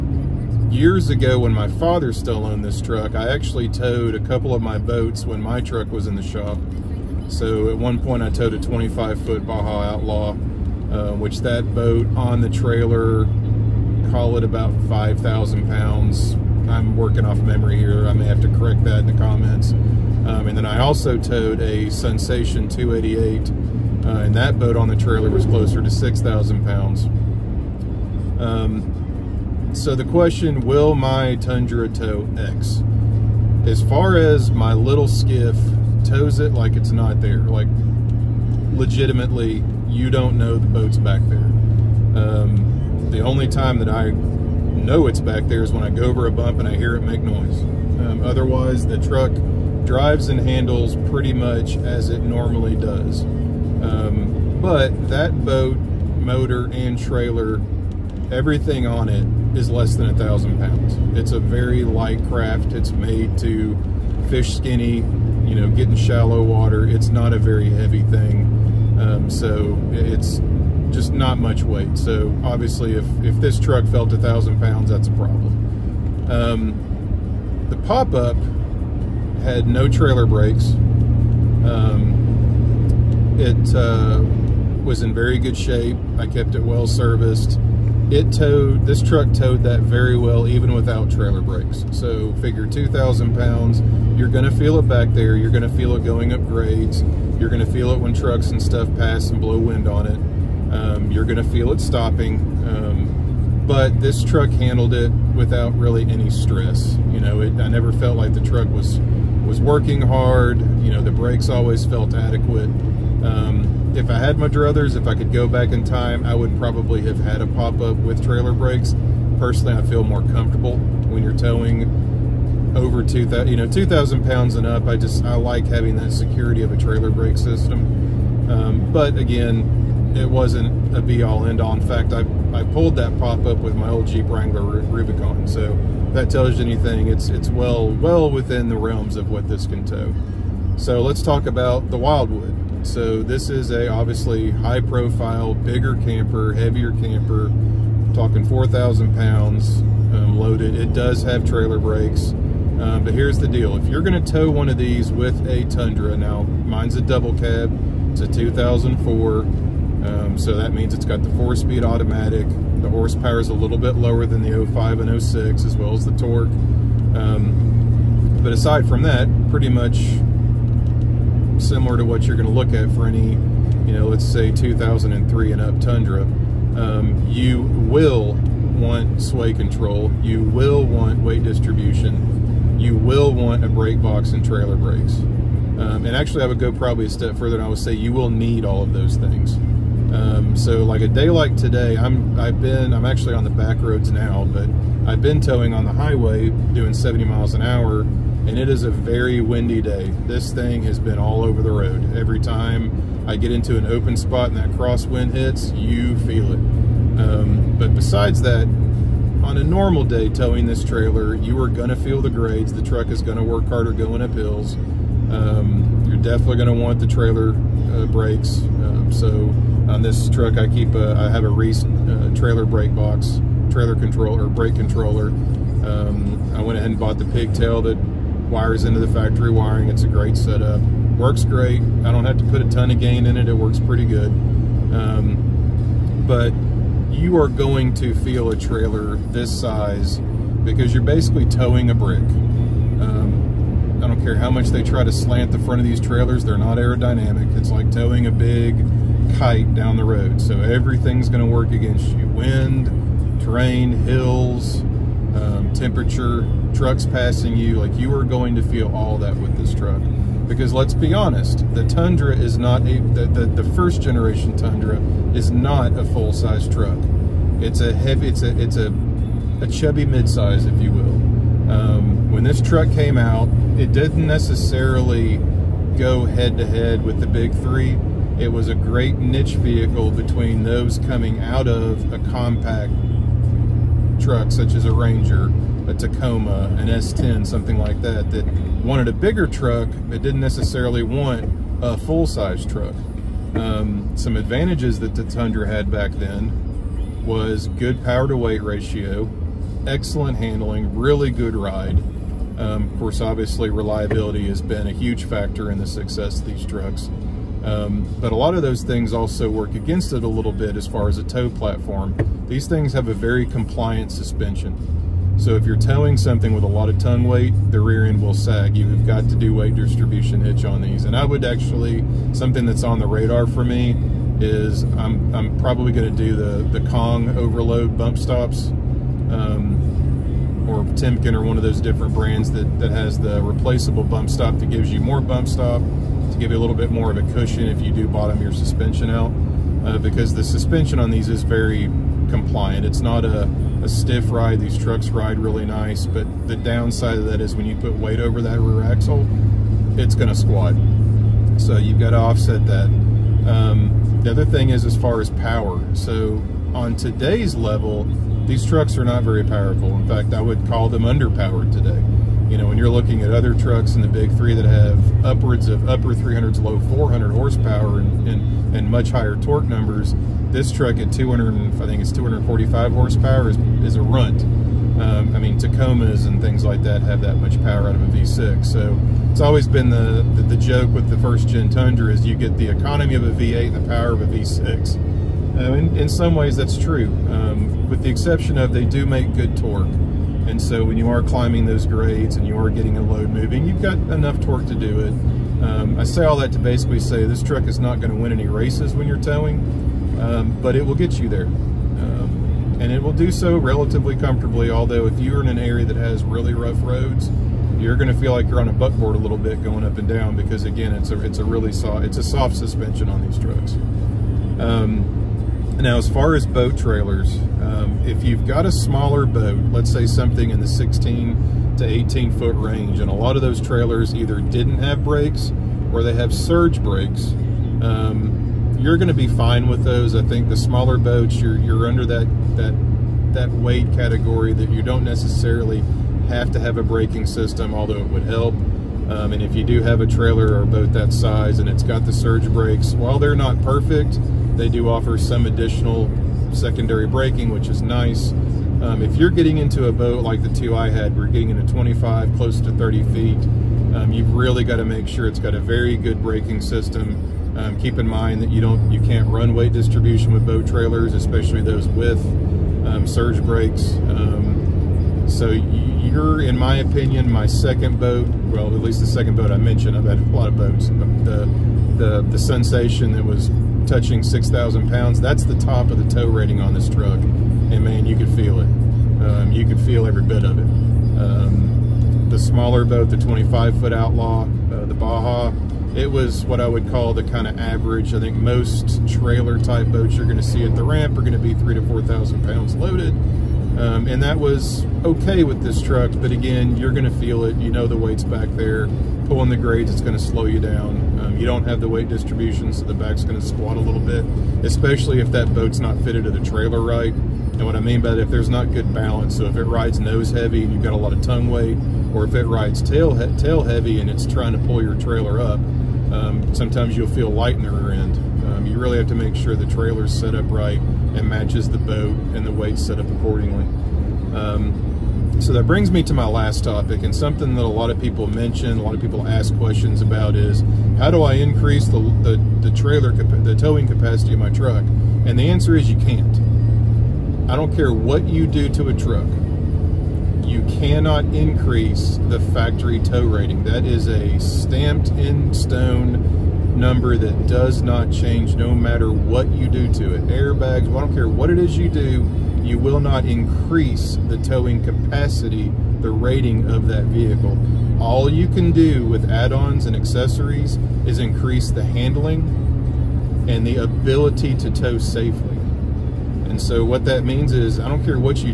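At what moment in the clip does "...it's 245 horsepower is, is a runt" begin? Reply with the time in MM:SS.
06:12.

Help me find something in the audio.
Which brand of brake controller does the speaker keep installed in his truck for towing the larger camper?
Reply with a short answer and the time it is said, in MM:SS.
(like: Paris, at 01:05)
Reese, at 03:41.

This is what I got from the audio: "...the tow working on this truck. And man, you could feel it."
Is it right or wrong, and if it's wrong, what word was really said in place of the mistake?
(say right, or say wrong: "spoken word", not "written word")
wrong: "rating", not "working".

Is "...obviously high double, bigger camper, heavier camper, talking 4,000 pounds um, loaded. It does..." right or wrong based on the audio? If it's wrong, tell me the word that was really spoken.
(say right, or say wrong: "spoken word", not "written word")
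wrong: "profile", not "double".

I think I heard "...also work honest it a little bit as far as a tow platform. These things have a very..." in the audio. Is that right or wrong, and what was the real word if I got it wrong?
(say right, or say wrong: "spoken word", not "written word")
wrong: "against", not "honest".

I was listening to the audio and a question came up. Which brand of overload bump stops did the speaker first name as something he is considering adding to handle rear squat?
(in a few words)
Kong.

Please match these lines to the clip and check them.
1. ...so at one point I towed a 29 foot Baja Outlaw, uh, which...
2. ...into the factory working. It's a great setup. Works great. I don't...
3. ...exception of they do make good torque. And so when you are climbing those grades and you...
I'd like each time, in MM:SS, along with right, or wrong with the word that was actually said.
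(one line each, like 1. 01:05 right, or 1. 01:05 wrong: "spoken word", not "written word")
1. 00:07 wrong: "25", not "29"
2. 03:48 wrong: "wiring", not "working"
3. 06:28 right.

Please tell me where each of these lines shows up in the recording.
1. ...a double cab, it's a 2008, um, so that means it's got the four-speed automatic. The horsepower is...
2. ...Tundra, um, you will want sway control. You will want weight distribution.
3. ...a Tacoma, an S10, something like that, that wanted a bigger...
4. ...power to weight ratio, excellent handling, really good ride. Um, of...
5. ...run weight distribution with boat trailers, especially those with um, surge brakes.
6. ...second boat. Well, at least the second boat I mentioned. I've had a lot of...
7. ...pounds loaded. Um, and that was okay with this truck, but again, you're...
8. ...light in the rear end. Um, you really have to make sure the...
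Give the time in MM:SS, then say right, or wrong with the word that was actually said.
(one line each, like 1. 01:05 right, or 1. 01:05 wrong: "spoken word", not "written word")
1. 02:36 wrong: "2004", not "2008"
2. 02:55 right
3. 04:45 right
4. 04:58 right
5. 07:39 right
6. 07:47 right
7. 08:12 right
8. 08:37 right.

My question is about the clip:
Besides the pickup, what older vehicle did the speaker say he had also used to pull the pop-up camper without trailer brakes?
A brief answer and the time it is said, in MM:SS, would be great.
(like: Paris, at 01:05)
Jeep Wrangler Rubicon, at 02:14.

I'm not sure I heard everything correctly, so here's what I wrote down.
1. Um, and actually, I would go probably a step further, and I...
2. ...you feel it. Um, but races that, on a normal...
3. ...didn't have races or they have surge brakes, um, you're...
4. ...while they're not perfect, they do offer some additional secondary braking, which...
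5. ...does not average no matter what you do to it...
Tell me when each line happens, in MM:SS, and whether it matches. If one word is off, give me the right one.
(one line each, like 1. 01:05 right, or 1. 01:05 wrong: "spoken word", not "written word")
1. 03:05 right
2. 03:25 wrong: "besides", not "races"
3. 07:04 wrong: "brakes", not "races"
4. 07:22 right
5. 09:07 wrong: "change", not "average".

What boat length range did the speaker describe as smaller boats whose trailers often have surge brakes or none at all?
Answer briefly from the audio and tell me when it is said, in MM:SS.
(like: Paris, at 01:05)
16 to 18 foot, at 07:00.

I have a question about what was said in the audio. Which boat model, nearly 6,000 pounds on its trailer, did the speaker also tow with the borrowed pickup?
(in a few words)
Sensation 288.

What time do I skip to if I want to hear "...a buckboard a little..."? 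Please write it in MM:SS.
06:48.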